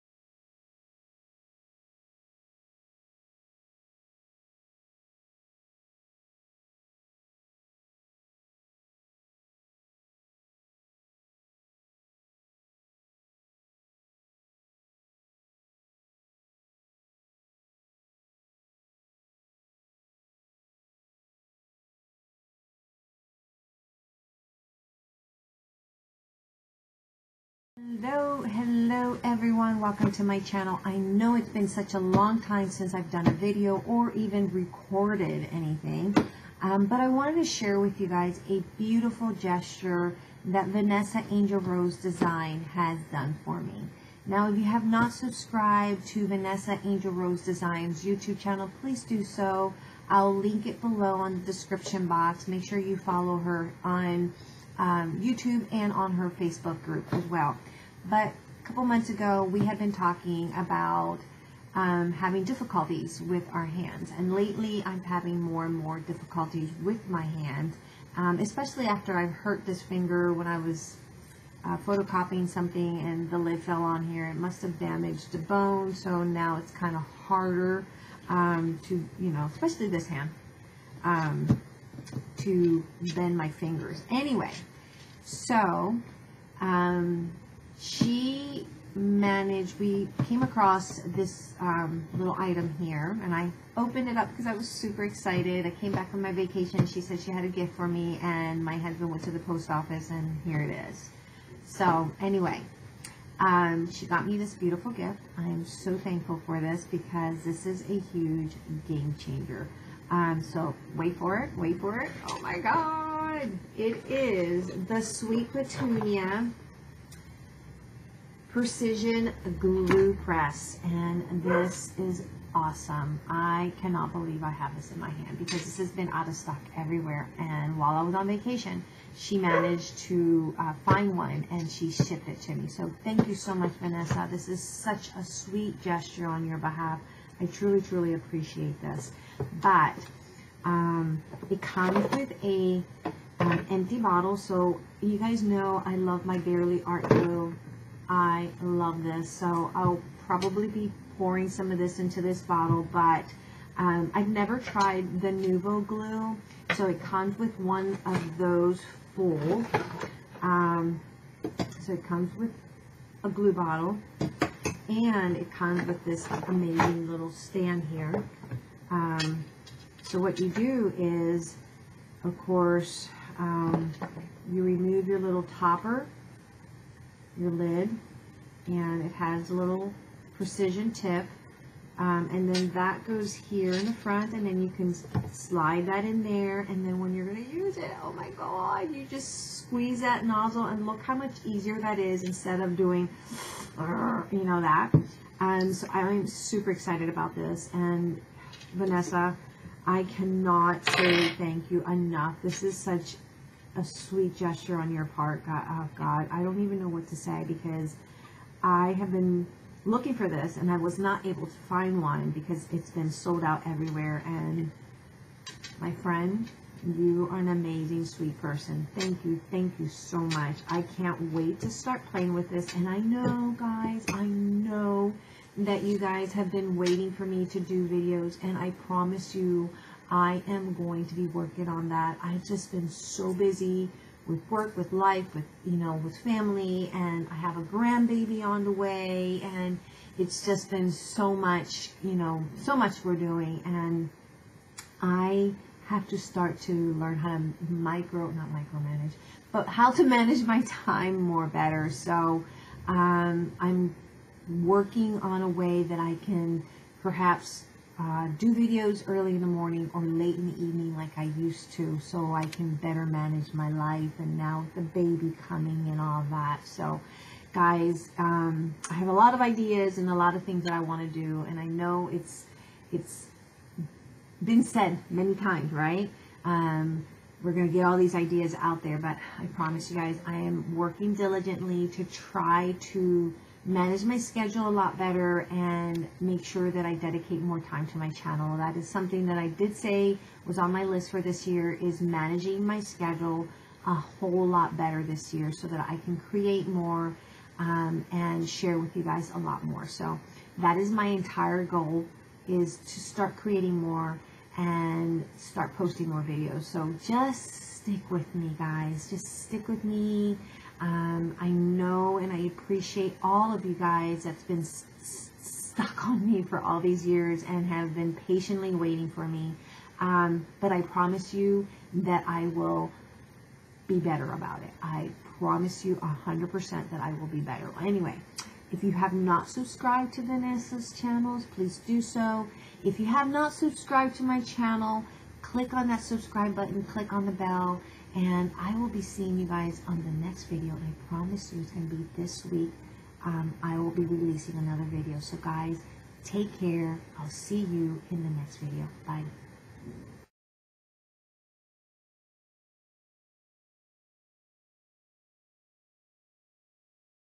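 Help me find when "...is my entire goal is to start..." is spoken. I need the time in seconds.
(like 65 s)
300 s.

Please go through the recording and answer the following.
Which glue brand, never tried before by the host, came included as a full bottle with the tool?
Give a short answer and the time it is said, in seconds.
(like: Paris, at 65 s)
Nuvo, at 155 s.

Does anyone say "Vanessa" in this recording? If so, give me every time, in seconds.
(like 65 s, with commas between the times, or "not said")
40 s, 46 s, 133 s, 198 s, 330 s.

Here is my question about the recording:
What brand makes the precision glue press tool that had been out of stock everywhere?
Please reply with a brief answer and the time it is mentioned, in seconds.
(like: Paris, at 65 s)
Sweet Petunia, at 115 s.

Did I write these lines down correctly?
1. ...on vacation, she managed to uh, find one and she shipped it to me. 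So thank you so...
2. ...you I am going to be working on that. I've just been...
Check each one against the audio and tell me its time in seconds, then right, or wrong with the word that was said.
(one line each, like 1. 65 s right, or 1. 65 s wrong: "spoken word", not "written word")
1. 128 s right
2. 229 s right.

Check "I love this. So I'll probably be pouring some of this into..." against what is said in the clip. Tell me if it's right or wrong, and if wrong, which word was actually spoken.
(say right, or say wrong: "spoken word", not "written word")
right.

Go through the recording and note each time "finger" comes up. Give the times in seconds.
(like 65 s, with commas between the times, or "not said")
69 s, 83 s.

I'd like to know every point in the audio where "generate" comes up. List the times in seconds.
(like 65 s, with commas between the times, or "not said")
not said.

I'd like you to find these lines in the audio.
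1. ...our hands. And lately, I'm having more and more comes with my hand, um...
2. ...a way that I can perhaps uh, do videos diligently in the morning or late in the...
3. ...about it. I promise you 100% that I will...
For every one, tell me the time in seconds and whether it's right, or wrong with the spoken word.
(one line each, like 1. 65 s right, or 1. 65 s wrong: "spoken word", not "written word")
1. 63 s wrong: "difficulties", not "comes"
2. 255 s wrong: "early", not "diligently"
3. 324 s right.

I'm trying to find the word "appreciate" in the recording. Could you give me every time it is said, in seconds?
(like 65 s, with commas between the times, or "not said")
138 s, 312 s.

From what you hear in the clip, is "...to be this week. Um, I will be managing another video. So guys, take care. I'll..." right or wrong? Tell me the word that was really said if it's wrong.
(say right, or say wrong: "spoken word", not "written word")
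wrong: "releasing", not "managing".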